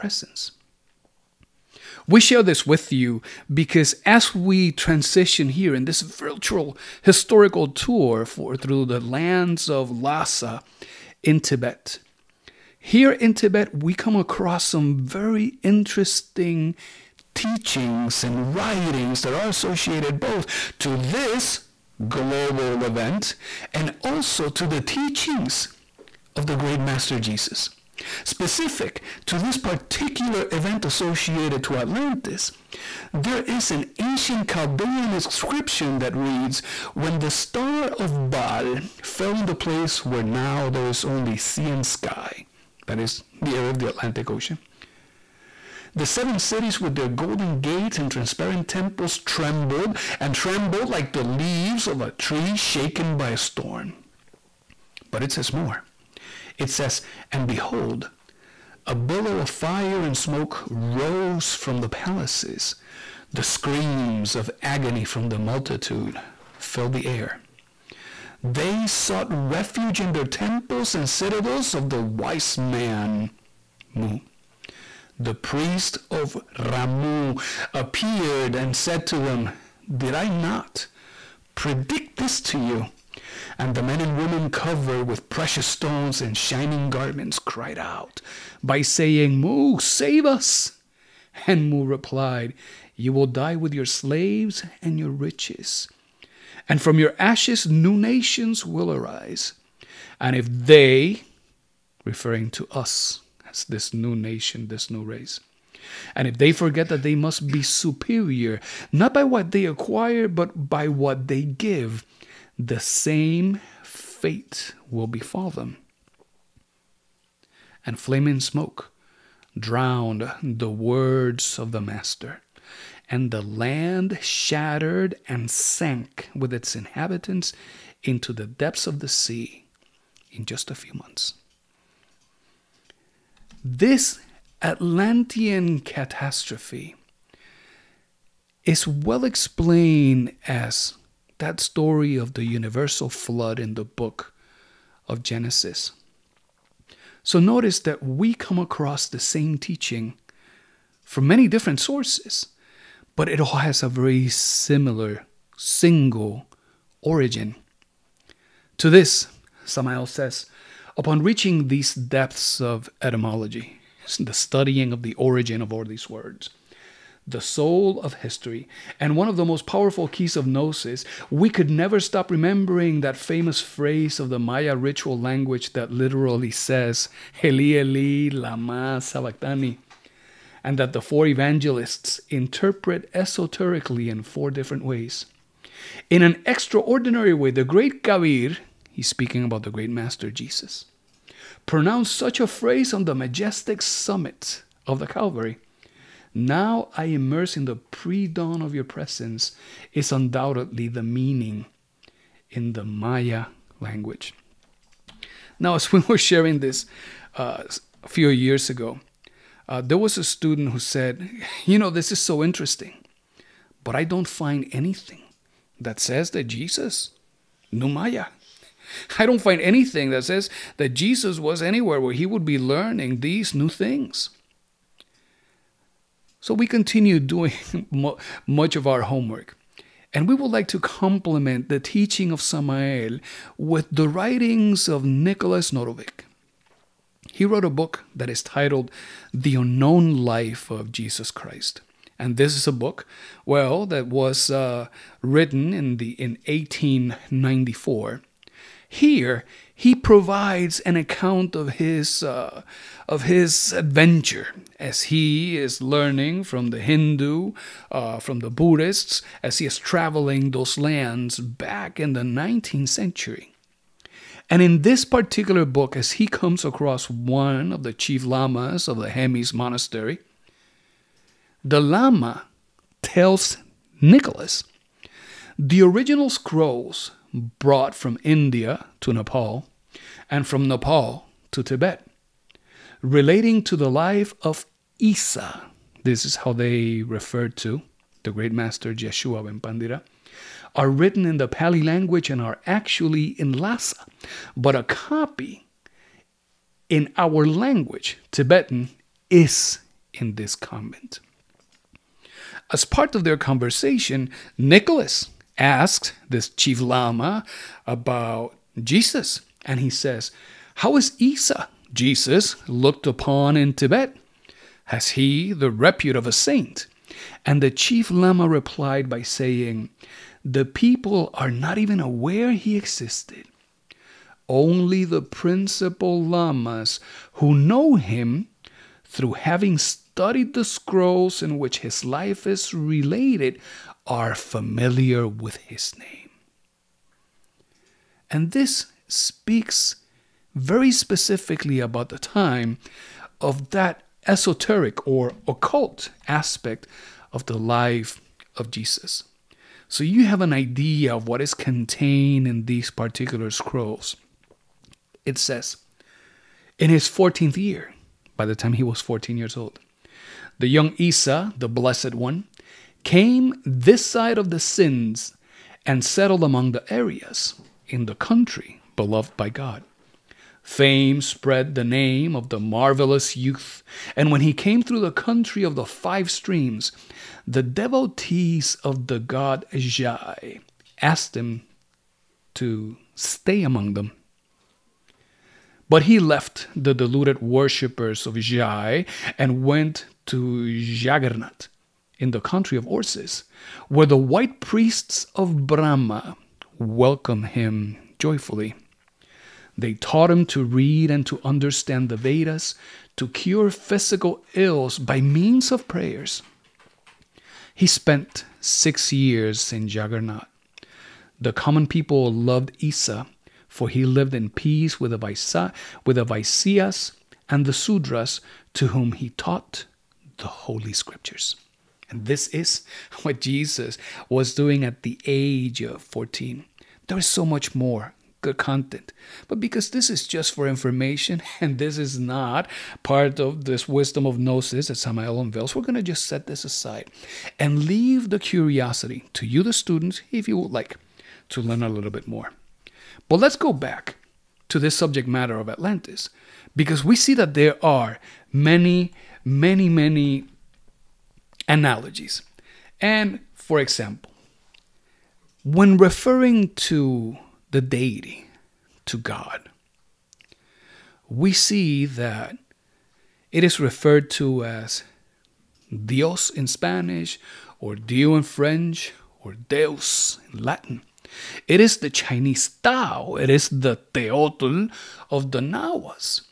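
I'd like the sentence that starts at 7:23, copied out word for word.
But let's go back to this subject matter of Atlantis because we see that there are many, many, many analogies.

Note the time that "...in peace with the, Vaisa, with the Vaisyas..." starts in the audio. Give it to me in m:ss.
6:54.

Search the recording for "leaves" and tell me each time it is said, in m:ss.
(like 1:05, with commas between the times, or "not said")
0:51, 7:17.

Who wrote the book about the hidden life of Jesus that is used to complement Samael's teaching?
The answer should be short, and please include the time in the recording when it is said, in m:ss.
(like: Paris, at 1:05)
Nicholas Notovitch, at 3:55.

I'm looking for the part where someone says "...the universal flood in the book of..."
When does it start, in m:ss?
2:22.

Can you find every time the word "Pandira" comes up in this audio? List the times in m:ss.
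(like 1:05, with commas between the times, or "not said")
4:49.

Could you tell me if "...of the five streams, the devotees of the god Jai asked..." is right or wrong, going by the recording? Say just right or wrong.
right.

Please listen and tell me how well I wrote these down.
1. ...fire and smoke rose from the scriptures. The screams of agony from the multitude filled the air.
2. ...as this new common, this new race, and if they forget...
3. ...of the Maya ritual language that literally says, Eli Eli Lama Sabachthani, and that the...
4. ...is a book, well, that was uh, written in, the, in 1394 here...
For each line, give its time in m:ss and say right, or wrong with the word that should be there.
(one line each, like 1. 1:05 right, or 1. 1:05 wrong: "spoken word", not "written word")
1. 0:59 wrong: "palaces", not "scriptures"
2. 1:43 wrong: "nation", not "common"
3. 2:54 right
4. 4:02 wrong: "1894", not "1394".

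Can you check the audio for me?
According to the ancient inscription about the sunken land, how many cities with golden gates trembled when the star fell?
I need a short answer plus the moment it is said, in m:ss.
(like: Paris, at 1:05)
7, at 0:46.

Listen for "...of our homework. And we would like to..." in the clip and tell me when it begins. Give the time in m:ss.
3:48.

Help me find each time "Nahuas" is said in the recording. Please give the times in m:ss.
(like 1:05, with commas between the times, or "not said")
7:55.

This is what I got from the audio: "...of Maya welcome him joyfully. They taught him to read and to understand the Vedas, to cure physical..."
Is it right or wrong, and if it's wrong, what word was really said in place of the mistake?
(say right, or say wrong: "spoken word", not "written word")
wrong: "Brahma", not "Maya".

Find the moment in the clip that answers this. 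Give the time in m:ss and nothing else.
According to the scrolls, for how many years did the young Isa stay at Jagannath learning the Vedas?
6:48.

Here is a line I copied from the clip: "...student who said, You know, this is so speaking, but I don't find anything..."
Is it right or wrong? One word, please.
wrong.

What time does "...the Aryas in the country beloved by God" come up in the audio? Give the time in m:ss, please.
6:06.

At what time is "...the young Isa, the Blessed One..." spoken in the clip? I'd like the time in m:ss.
6:00.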